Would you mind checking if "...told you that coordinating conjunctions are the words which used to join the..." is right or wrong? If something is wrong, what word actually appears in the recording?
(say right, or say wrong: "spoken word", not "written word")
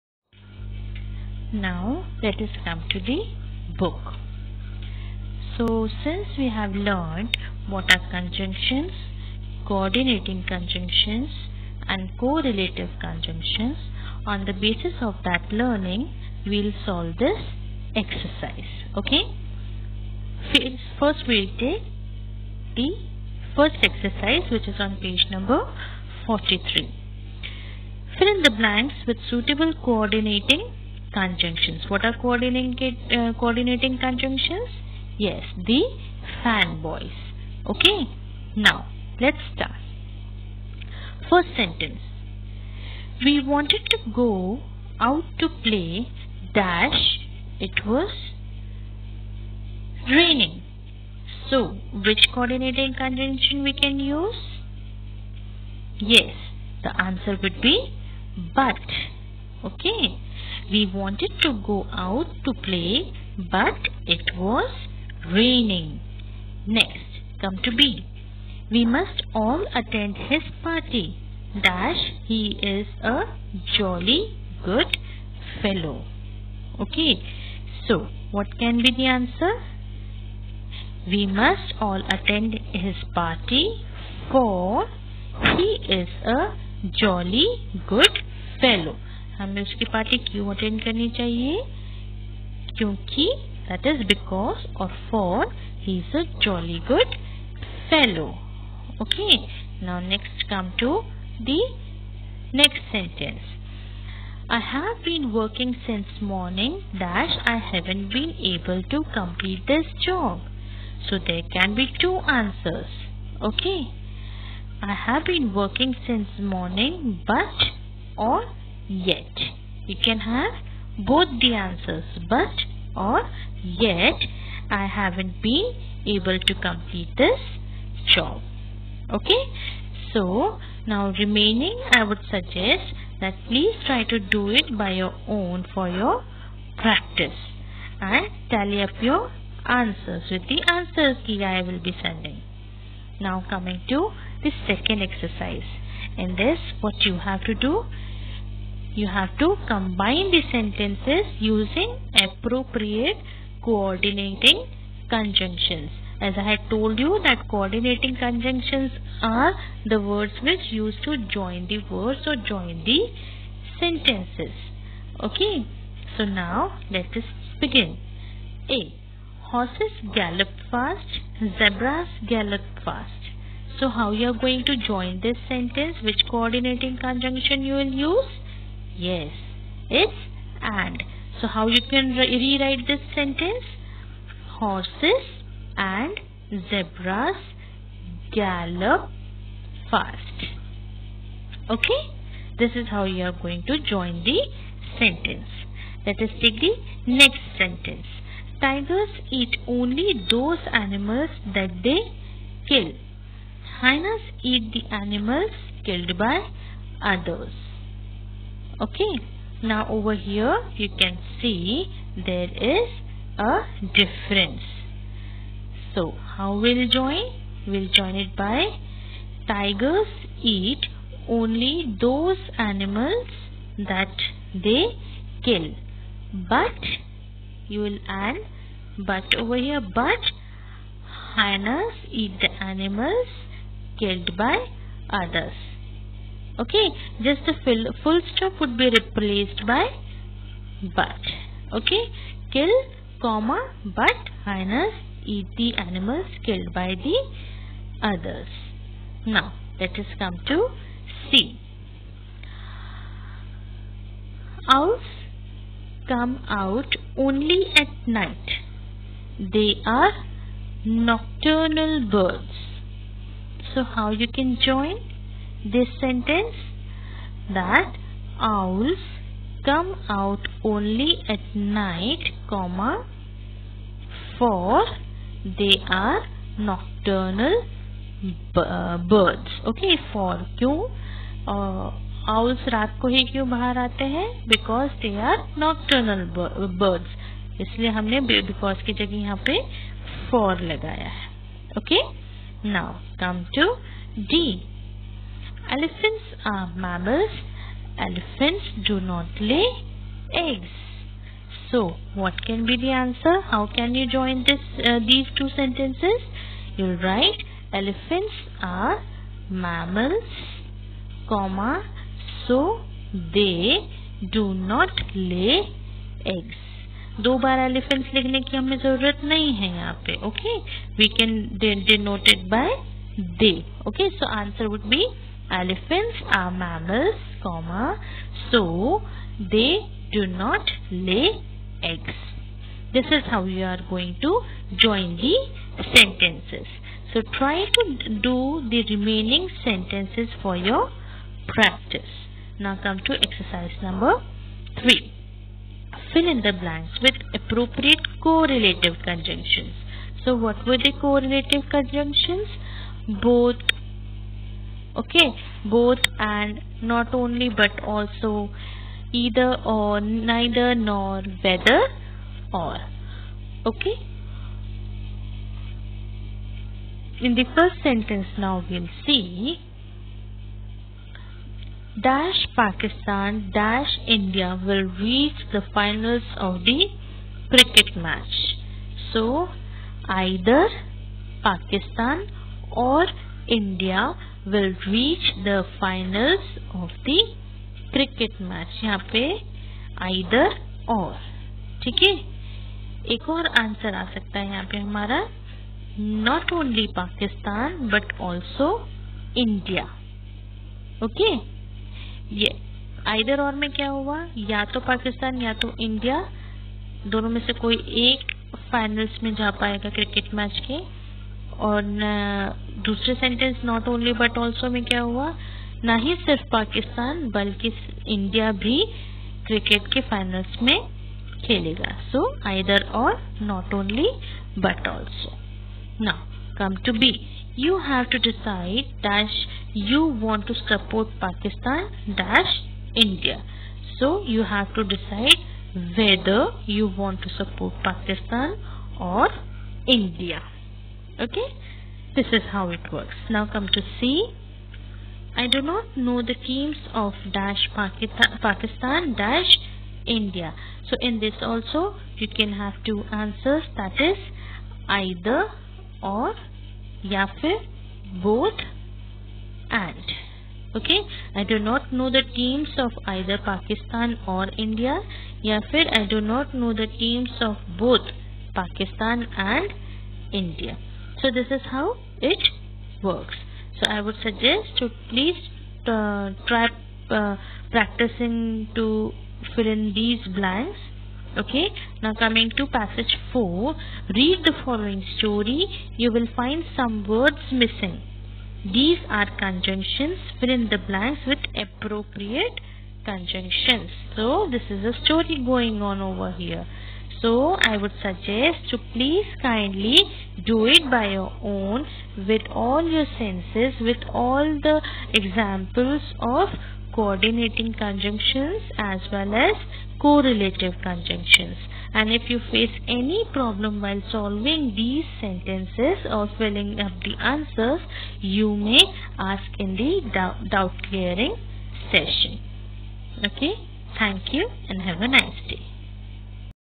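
right.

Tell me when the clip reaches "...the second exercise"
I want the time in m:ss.
2:24.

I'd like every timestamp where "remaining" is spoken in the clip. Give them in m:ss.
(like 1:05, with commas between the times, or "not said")
2:11, 5:38.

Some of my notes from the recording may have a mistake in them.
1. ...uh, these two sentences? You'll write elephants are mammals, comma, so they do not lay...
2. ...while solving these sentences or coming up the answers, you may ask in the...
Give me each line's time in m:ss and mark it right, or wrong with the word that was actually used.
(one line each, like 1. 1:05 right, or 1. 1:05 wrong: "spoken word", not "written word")
1. 5:04 right
2. 8:33 wrong: "filling", not "coming".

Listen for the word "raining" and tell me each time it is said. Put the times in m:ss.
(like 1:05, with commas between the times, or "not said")
0:50, 1:05.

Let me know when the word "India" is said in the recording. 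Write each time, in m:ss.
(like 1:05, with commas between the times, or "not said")
6:14, 6:23, 6:39, 7:30, 7:44, 7:50.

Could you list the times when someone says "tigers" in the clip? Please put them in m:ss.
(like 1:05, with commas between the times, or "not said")
3:18, 3:39.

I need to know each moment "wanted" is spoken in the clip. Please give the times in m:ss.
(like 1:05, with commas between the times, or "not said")
0:43, 1:00.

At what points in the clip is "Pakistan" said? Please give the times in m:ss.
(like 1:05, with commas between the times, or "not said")
6:12, 6:21, 6:36, 7:27, 7:43, 7:48.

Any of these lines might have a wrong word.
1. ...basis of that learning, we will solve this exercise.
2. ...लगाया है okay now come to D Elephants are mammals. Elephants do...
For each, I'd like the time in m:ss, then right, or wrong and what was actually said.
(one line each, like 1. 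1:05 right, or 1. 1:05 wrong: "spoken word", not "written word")
1. 0:14 right
2. 4:50 right.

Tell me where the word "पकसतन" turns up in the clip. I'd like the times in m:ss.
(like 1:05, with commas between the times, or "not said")
6:44, 6:56, 7:11, 7:17.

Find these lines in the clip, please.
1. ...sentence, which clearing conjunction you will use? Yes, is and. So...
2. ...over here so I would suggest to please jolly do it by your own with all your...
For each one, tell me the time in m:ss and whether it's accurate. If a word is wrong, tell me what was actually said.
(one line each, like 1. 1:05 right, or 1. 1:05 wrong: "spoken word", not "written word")
1. 2:55 wrong: "coordinating", not "clearing"
2. 8:16 wrong: "kindly", not "jolly".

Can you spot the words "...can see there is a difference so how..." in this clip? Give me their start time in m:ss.
3:30.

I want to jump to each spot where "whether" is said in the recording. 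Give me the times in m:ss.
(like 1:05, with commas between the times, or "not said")
6:01.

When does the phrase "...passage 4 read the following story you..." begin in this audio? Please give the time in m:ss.
8:02.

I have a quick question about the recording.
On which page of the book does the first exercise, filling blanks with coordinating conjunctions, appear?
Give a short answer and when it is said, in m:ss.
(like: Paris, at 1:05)
43, at 0:26.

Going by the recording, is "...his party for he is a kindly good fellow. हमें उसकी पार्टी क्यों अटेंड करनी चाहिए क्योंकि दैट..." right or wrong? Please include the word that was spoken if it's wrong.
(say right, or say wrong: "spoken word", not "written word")
wrong: "jolly", not "kindly".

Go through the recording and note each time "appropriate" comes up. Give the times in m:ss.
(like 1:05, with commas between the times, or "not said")
2:32, 5:47, 8:11.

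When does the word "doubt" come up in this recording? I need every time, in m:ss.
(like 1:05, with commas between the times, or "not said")
8:40.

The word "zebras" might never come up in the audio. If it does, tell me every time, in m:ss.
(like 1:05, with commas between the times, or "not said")
2:51, 3:06.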